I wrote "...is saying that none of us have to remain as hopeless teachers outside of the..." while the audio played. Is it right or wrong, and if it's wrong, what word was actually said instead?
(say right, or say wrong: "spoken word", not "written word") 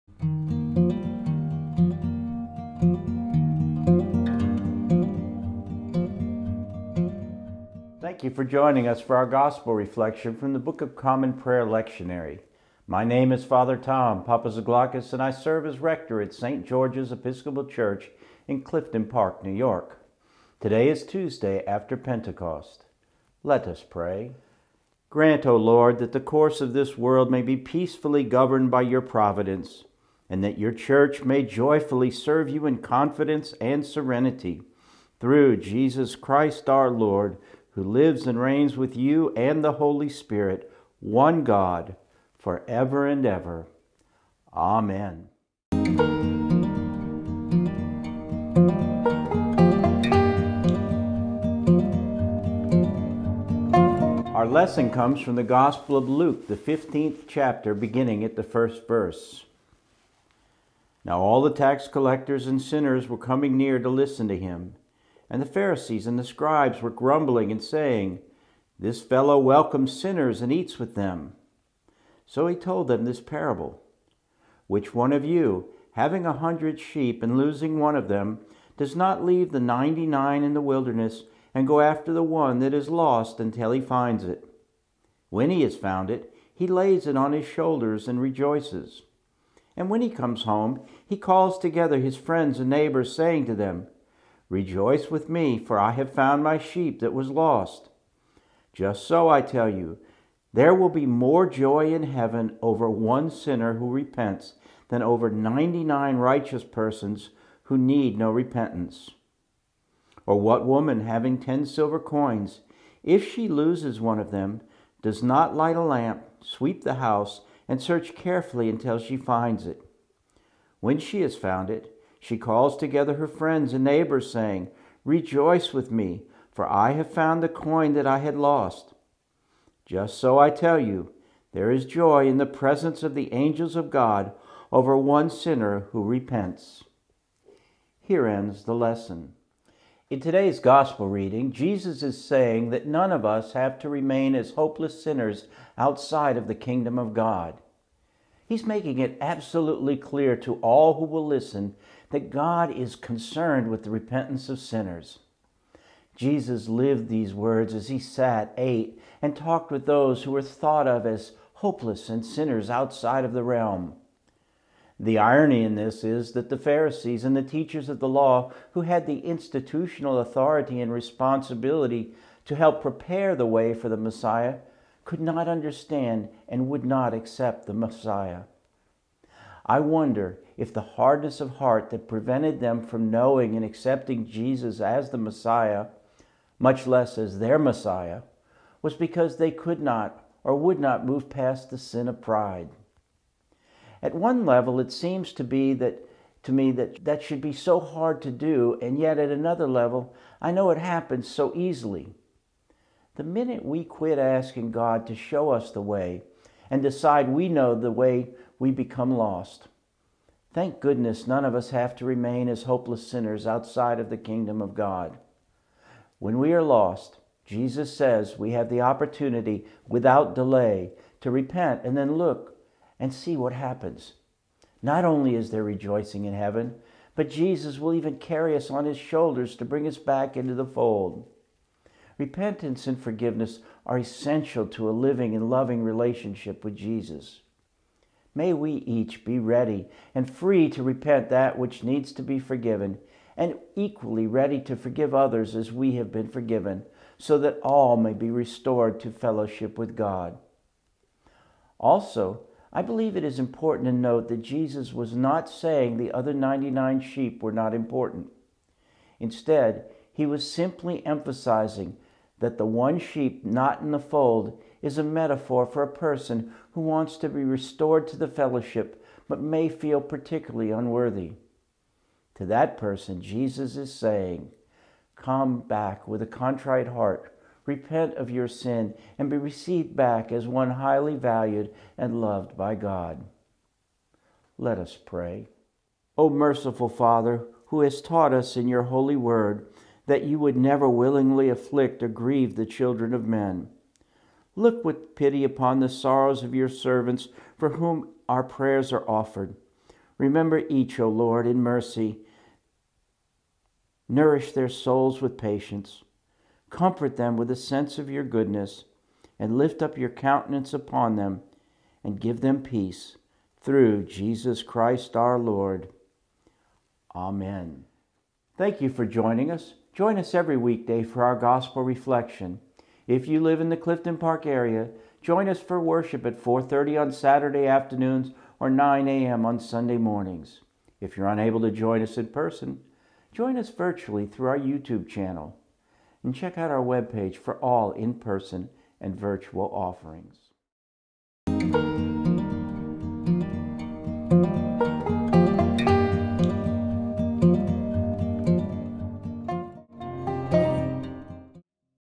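wrong: "sinners", not "teachers".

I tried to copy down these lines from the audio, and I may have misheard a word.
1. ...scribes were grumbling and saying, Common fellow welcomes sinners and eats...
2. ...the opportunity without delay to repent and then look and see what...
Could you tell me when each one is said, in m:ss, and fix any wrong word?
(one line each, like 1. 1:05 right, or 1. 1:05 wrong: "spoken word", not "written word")
1. 1:06 wrong: "This", not "Common"
2. 3:38 right.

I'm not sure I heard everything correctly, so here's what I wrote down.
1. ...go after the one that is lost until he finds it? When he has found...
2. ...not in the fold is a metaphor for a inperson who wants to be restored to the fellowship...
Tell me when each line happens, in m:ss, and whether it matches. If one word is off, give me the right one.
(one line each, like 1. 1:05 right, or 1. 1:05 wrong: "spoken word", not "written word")
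1. 1:21 right
2. 4:23 wrong: "person", not "inperson".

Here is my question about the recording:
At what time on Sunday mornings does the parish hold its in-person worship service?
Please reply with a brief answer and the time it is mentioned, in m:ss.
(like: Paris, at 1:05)
9 a.m., at 5:28.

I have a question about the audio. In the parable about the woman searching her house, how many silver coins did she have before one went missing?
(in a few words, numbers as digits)
10.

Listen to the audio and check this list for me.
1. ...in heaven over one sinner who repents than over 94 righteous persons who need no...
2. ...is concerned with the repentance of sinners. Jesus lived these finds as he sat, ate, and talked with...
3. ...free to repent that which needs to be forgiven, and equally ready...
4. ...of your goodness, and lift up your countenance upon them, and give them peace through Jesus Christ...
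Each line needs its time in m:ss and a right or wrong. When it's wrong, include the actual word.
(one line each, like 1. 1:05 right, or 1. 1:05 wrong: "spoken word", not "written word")
1. 1:41 wrong: "99", not "94"
2. 2:32 wrong: "words", not "finds"
3. 4:00 right
4. 5:07 right.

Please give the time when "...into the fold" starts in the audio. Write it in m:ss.
3:50.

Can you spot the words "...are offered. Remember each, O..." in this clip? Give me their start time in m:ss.
4:58.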